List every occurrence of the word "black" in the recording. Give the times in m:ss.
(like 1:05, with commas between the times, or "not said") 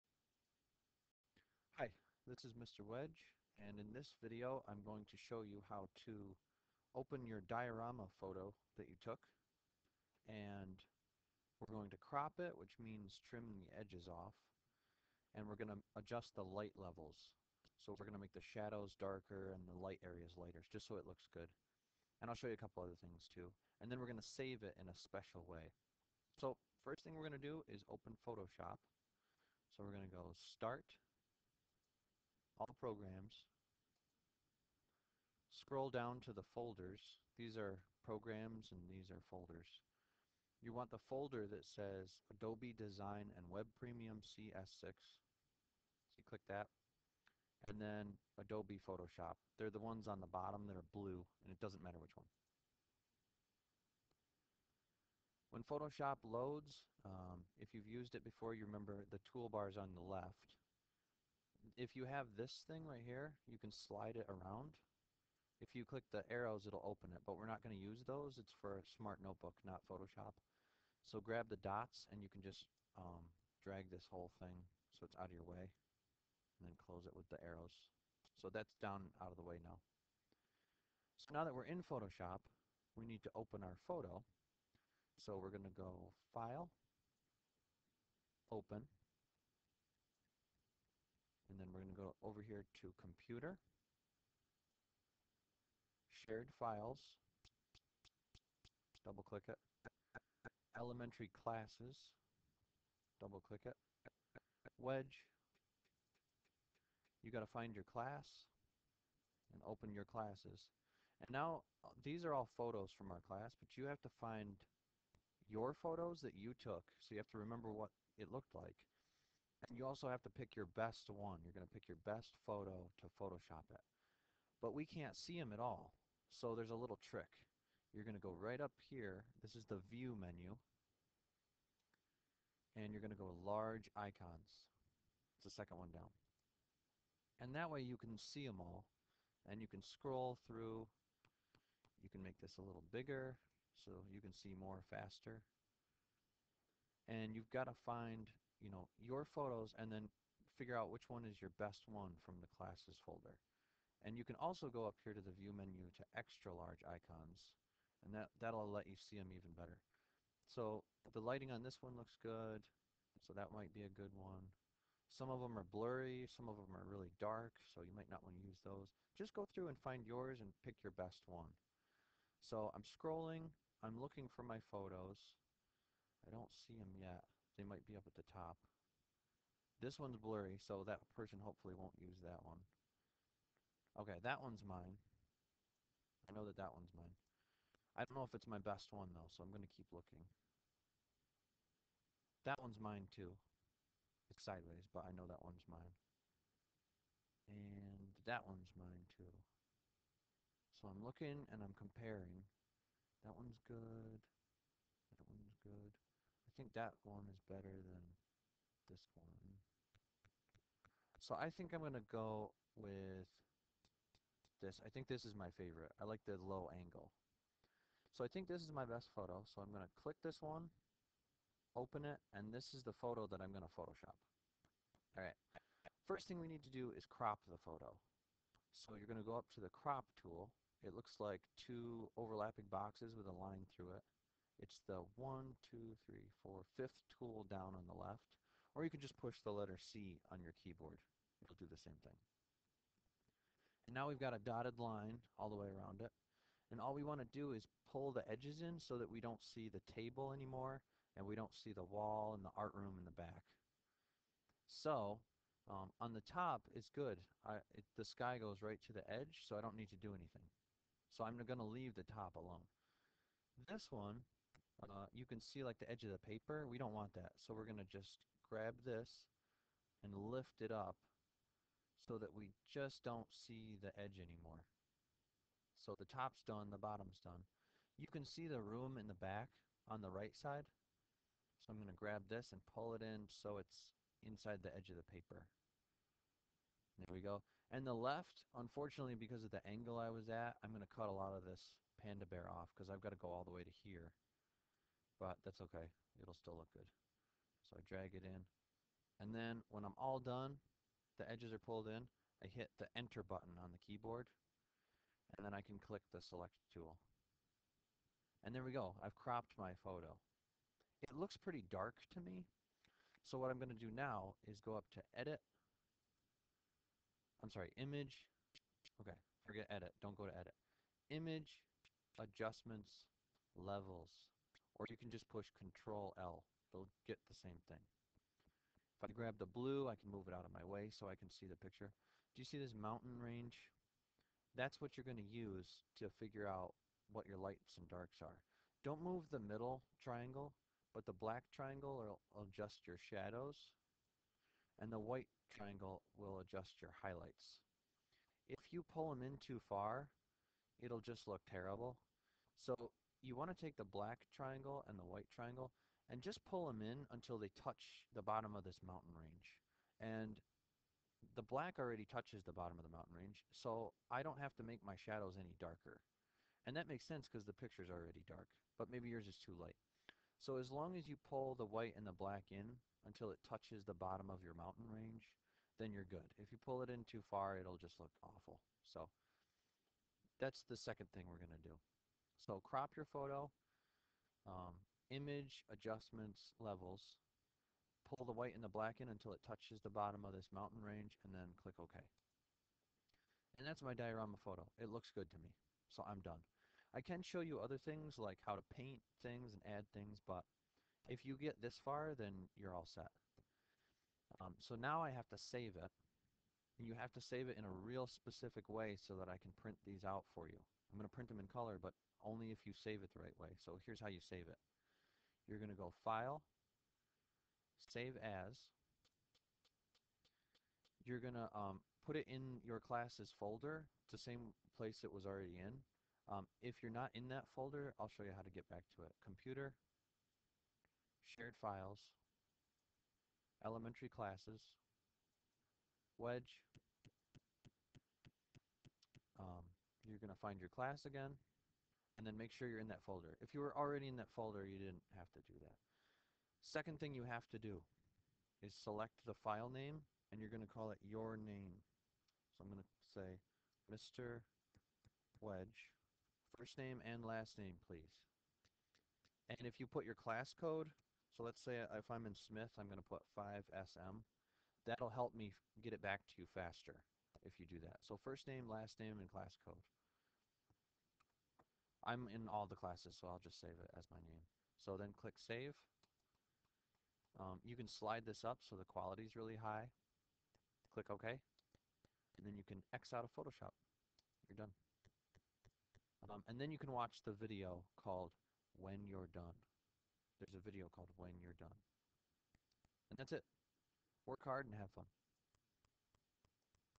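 5:41, 5:53, 6:01, 6:12, 6:28.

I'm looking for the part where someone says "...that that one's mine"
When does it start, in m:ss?
3:06.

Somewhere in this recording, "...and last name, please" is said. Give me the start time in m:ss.
7:37.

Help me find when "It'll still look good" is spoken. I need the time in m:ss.
4:56.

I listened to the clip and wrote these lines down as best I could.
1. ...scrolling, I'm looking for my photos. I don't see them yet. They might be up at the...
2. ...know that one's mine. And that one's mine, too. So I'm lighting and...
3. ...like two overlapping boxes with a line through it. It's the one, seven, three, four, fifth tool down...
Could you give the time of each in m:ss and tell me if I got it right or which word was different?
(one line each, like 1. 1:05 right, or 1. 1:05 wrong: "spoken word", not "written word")
1. 2:52 right
2. 3:15 wrong: "looking", not "lighting"
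3. 3:51 wrong: "two", not "seven".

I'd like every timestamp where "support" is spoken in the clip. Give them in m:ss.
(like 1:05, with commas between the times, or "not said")
not said.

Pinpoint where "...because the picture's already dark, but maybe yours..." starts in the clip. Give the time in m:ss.
6:07.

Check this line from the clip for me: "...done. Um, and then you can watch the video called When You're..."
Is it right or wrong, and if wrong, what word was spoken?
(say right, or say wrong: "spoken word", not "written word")
right.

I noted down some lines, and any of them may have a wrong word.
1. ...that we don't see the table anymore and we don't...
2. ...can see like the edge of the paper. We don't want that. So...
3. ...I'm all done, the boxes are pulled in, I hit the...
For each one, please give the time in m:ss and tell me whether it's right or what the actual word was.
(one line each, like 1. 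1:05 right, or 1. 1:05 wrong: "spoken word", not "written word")
1. 4:08 right
2. 4:25 right
3. 4:59 wrong: "edges", not "boxes".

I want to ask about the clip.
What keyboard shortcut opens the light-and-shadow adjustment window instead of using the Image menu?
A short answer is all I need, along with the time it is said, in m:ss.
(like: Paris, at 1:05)
Control L, at 5:25.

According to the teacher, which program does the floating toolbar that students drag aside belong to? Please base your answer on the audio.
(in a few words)
Smart Notebook.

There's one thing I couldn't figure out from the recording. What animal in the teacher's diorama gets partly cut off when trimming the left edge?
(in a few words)
panda bear.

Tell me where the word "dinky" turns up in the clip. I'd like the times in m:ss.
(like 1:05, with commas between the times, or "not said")
not said.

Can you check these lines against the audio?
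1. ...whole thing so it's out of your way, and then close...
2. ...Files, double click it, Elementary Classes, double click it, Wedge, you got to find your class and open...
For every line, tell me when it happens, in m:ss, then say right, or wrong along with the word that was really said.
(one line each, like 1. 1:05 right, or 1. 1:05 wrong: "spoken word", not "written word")
1. 1:14 right
2. 1:36 right.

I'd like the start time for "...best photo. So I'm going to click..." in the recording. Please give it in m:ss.
3:38.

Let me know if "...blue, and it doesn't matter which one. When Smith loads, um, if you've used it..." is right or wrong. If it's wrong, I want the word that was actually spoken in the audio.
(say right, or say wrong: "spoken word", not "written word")
wrong: "Photoshop", not "Smith".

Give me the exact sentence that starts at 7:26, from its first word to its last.
Second thing you have to do is select the file name, and you're going to call it your name.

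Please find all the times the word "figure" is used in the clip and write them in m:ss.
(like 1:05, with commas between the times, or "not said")
2:30, 5:36.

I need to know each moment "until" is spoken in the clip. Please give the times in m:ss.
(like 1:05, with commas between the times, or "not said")
5:57, 6:13, 6:29.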